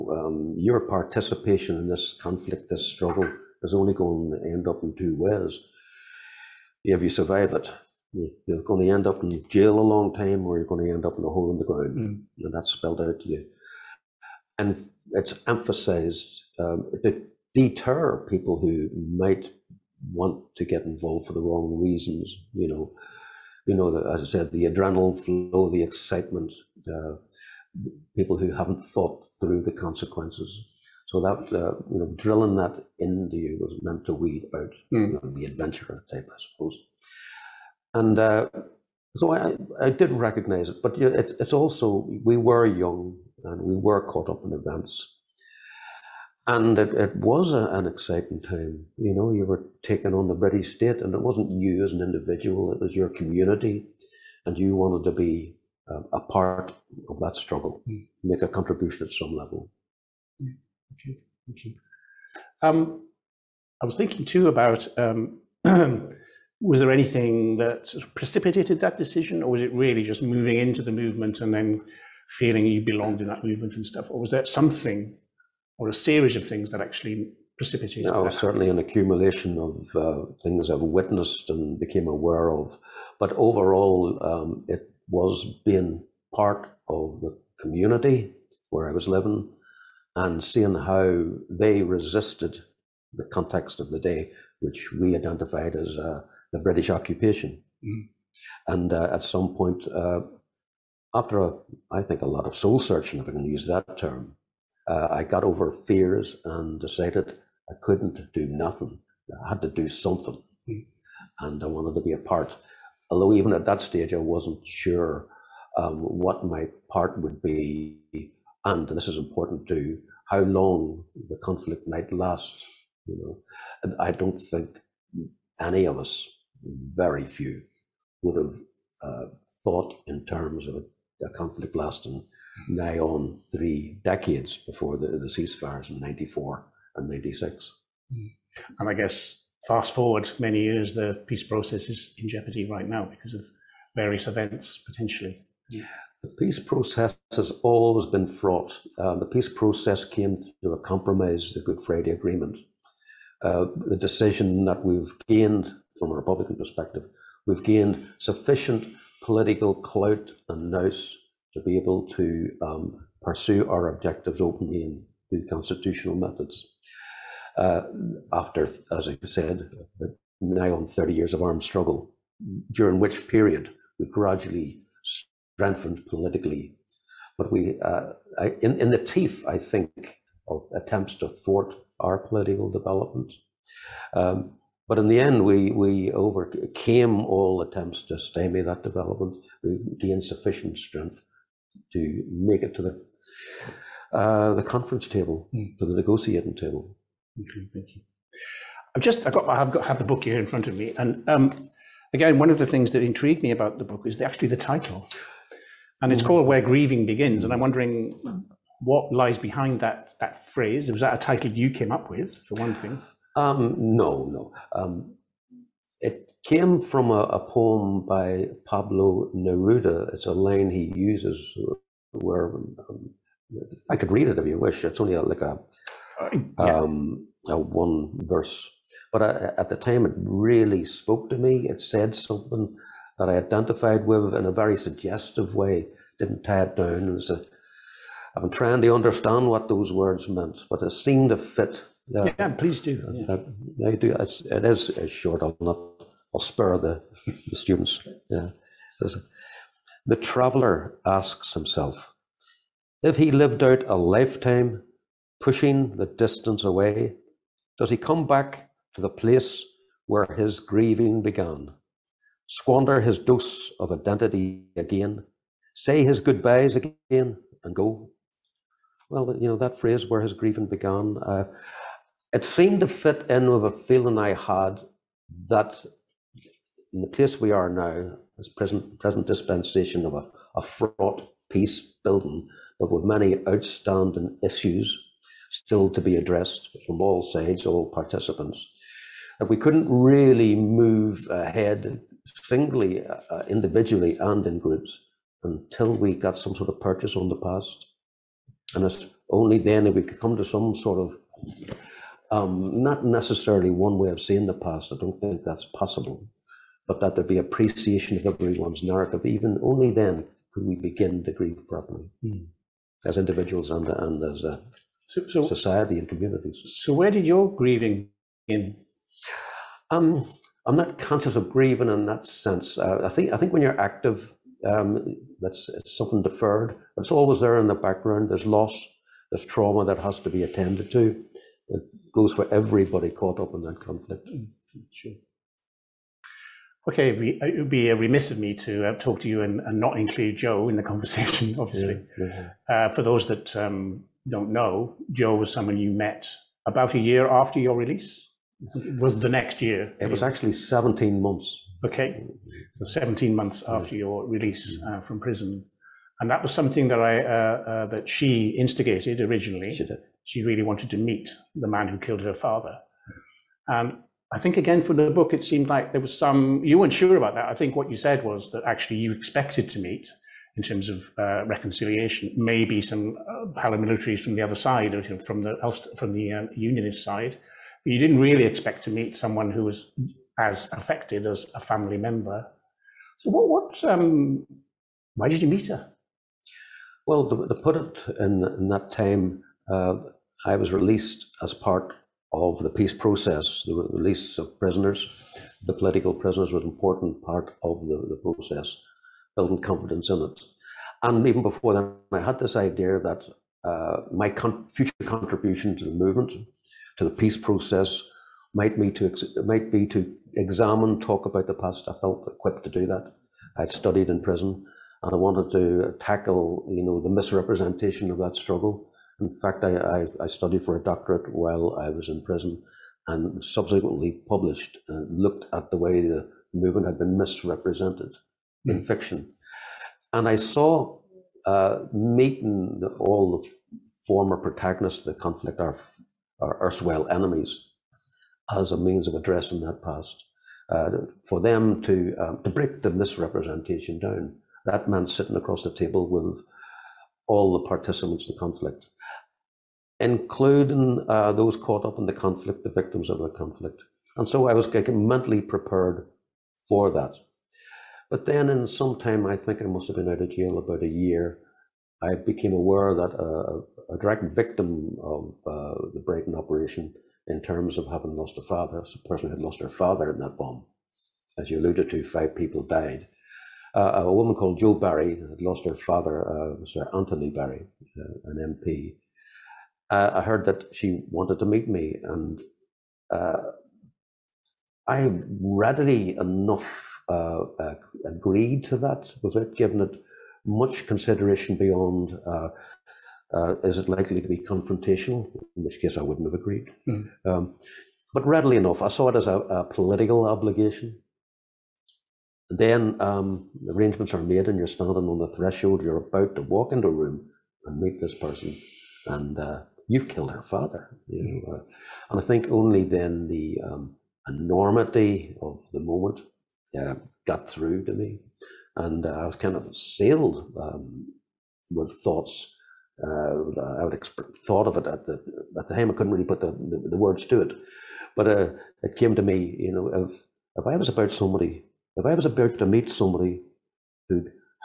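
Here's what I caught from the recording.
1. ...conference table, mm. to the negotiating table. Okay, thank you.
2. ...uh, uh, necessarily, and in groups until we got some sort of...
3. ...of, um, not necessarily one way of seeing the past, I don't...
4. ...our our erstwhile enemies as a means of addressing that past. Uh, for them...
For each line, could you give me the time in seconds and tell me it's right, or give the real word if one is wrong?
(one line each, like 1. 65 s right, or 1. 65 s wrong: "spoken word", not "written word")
1. 194 s right
2. 293 s wrong: "individually", not "necessarily"
3. 300 s right
4. 435 s right.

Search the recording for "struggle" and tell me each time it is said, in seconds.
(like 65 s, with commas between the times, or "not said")
2 s, 57 s, 171 s, 418 s.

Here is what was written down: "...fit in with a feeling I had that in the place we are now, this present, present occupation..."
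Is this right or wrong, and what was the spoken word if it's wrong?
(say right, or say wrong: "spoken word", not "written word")
wrong: "dispensation", not "occupation".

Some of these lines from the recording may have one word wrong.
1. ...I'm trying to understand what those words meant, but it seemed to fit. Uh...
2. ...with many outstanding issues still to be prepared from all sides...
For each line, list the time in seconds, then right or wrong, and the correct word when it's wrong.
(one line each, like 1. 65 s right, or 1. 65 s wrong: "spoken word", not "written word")
1. 238 s right
2. 282 s wrong: "addressed", not "prepared".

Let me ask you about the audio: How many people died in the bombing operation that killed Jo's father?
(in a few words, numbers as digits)
5.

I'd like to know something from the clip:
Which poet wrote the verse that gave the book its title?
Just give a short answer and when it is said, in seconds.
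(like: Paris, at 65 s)
Pablo Neruda, at 218 s.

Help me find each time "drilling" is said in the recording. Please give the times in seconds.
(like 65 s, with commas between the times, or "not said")
32 s.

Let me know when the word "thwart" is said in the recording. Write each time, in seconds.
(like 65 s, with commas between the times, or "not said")
181 s.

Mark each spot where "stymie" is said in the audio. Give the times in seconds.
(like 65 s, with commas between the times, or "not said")
188 s.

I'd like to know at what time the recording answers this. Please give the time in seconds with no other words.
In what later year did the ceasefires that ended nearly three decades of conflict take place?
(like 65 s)
137 s.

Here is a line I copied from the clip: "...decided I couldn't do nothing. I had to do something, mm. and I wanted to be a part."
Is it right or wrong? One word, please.
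right.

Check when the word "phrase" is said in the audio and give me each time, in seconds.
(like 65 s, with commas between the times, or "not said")
210 s, 269 s.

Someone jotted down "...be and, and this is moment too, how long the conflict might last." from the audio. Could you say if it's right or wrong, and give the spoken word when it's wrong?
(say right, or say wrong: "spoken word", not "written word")
wrong: "important", not "moment".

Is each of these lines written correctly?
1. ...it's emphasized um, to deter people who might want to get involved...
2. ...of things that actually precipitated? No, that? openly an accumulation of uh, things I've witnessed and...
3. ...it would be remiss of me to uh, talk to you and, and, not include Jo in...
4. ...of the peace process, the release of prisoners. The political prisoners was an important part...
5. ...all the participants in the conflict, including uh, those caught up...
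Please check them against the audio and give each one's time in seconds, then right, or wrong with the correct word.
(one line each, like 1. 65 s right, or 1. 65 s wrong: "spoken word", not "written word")
1. 15 s right
2. 76 s wrong: "certainly", not "openly"
3. 337 s right
4. 392 s right
5. 447 s right.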